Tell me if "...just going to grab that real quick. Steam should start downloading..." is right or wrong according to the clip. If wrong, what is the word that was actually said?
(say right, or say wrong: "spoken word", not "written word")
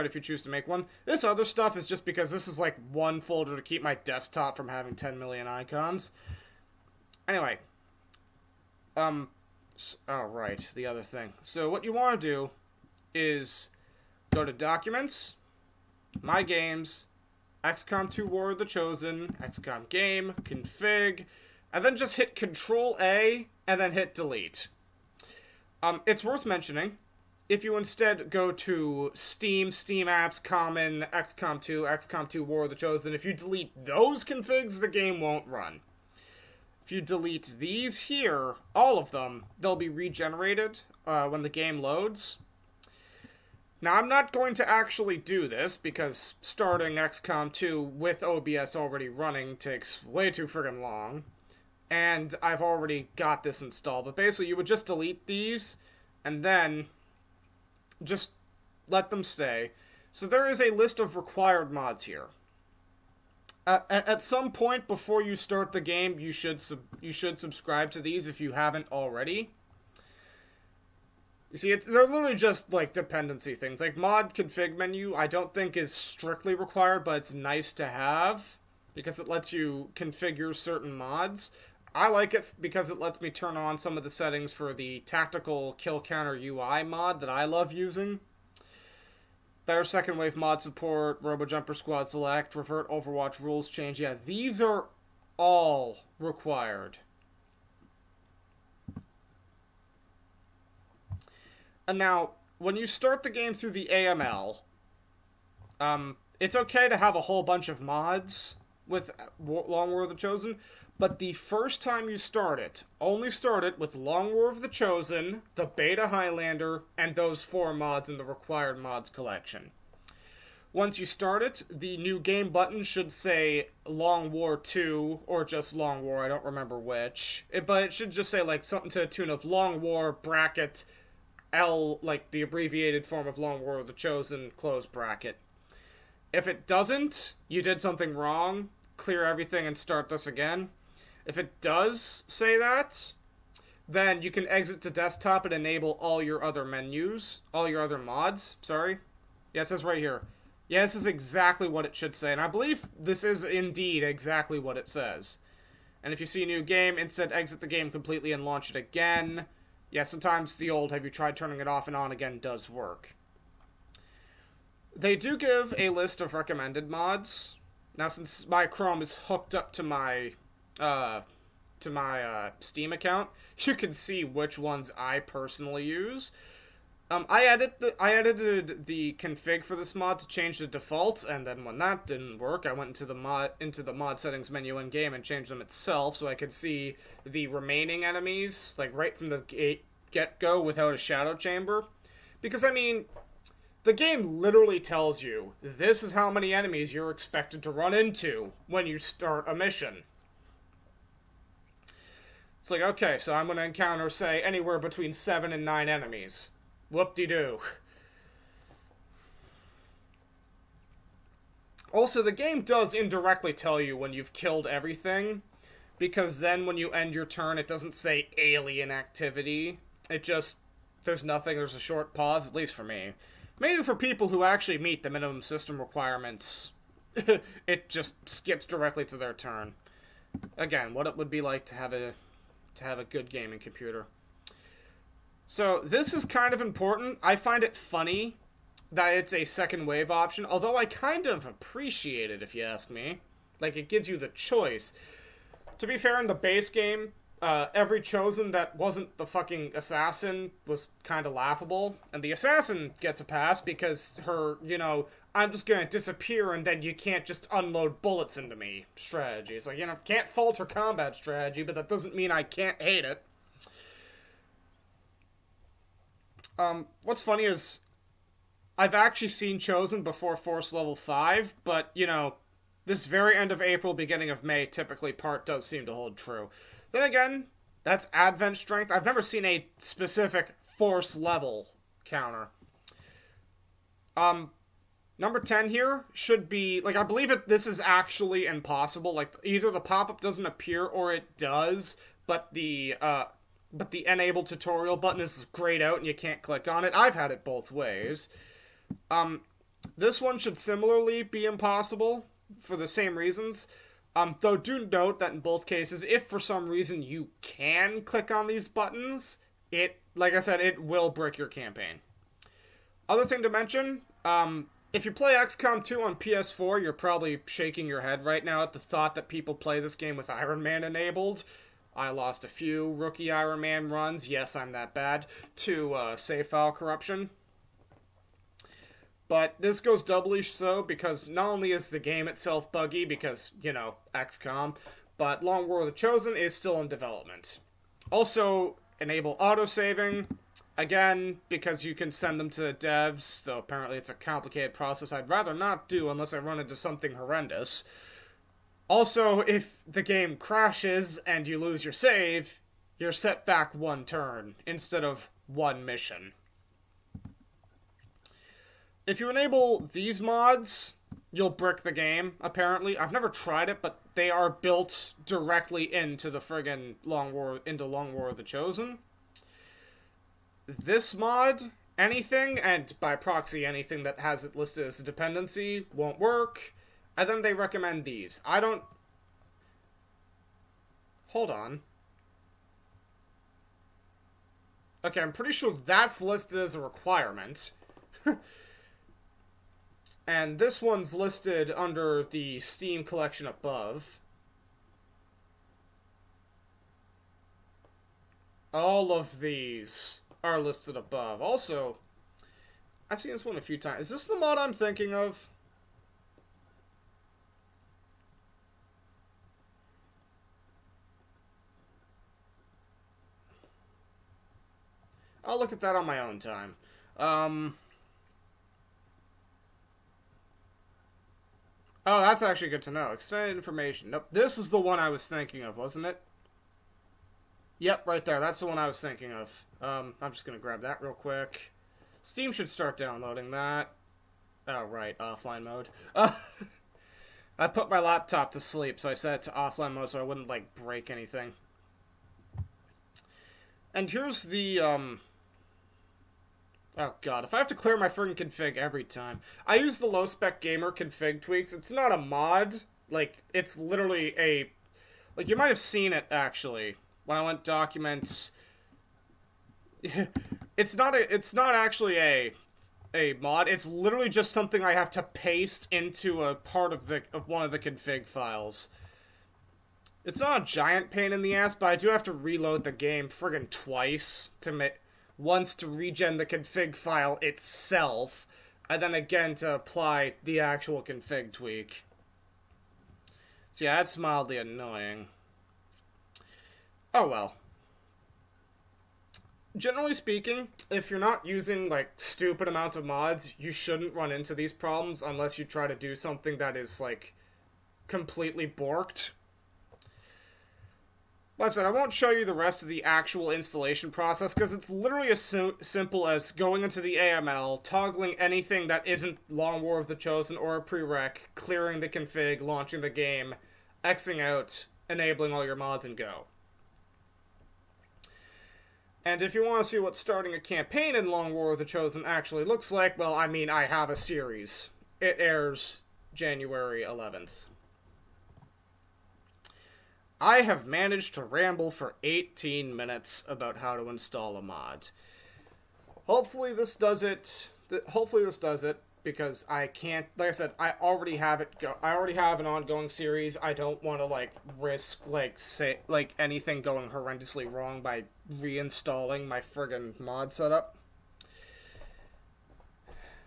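right.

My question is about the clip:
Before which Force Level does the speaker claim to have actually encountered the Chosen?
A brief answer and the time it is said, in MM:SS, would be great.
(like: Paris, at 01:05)
Force Level 5, at 04:30.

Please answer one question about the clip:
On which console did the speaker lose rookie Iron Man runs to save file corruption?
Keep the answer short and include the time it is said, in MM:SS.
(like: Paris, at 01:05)
PS4, at 05:16.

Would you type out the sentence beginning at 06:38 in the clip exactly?
All of these are listed above.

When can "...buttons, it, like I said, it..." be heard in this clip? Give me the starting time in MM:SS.
05:08.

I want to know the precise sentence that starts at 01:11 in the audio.
You see, it's, they're literally just like dependency things.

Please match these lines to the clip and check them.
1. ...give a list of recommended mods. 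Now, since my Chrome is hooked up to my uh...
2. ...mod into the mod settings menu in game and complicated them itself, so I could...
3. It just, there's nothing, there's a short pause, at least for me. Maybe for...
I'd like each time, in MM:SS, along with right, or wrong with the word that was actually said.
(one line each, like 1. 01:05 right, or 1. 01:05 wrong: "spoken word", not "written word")
1. 02:45 right
2. 03:03 wrong: "changed", not "complicated"
3. 03:40 right.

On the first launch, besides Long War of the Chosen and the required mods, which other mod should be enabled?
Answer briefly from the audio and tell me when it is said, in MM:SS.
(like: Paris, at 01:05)
Beta Highlander, at 01:55.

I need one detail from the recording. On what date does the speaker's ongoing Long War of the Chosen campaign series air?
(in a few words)
January 11th.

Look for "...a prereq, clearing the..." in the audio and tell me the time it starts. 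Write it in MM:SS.
08:30.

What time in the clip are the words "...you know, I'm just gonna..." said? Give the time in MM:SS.
04:14.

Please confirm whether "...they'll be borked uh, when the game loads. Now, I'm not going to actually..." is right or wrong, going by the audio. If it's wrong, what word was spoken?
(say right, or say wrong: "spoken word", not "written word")
wrong: "regenerated", not "borked".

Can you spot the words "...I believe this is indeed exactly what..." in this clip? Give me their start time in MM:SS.
02:32.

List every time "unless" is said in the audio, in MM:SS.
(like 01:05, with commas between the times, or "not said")
05:46, 08:15.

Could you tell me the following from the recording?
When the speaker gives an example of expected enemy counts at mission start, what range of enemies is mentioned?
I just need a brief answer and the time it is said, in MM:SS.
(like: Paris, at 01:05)
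7 to 9, at 03:25.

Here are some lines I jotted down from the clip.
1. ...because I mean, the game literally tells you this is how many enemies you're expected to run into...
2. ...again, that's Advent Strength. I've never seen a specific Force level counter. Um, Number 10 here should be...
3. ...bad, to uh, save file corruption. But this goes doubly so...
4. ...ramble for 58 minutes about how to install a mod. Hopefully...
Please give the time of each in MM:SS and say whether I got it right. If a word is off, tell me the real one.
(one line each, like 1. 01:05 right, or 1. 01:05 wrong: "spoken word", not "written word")
1. 03:12 right
2. 04:37 right
3. 05:24 right
4. 08:51 wrong: "18", not "58".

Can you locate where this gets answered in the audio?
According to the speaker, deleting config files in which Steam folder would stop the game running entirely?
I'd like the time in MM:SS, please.
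00:29.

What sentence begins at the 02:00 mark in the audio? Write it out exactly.
Once you start it, the new game button should say Long War 2 or just Long War, I don't remember which.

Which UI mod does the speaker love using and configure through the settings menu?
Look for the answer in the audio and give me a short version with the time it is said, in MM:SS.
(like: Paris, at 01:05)
Tactical kill counter, at 01:24.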